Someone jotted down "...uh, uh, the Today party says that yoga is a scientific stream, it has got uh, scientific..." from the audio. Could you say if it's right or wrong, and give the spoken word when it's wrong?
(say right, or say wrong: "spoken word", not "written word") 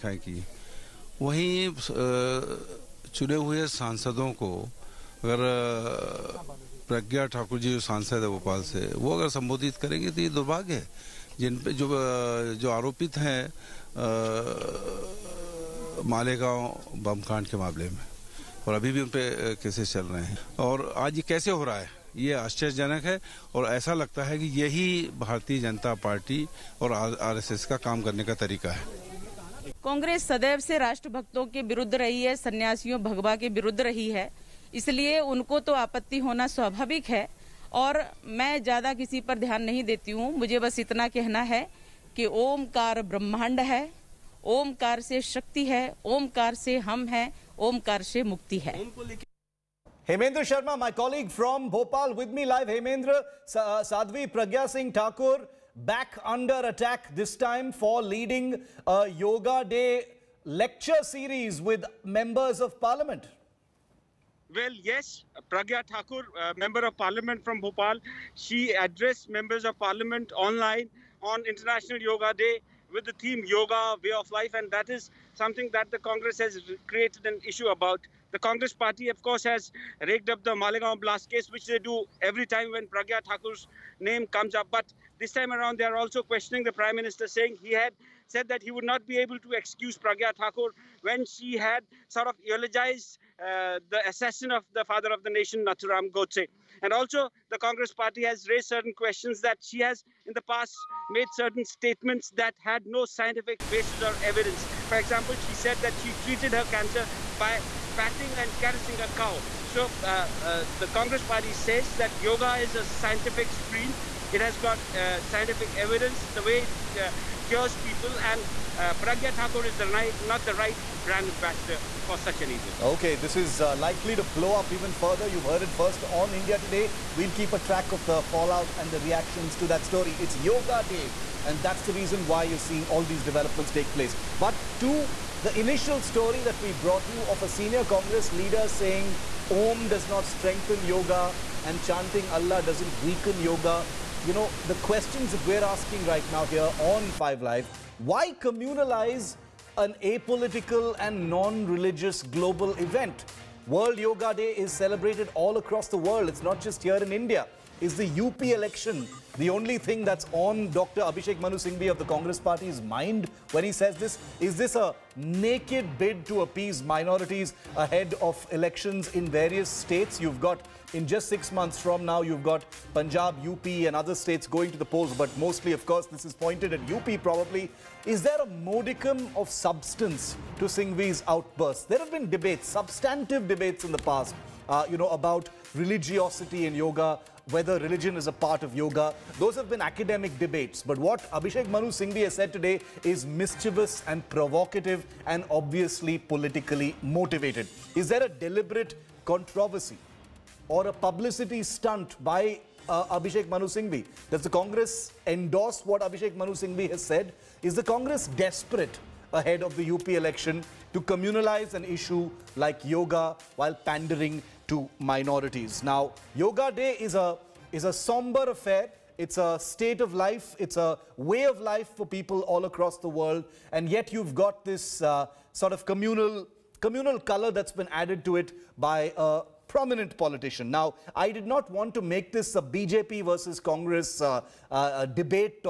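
wrong: "Congress", not "Today".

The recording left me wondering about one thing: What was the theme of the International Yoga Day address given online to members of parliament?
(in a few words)
Yoga, way of life.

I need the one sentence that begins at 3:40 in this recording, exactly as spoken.
It's a way of life for people all across the world.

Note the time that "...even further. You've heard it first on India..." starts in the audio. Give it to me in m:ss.
2:04.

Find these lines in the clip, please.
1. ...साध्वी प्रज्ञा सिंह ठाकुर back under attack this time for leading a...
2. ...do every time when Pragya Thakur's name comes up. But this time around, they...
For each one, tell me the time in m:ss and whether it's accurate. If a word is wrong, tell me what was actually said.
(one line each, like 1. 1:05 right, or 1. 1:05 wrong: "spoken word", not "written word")
1. 0:53 right
2. 1:21 right.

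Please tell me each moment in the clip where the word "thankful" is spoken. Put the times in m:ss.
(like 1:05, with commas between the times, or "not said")
not said.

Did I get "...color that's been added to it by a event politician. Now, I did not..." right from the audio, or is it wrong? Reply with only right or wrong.
wrong.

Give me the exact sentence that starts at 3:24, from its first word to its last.
Does the Congress endorse what Abhishek Manu Singhvi has said?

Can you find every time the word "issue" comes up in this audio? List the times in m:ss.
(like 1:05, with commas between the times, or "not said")
1:17, 3:31.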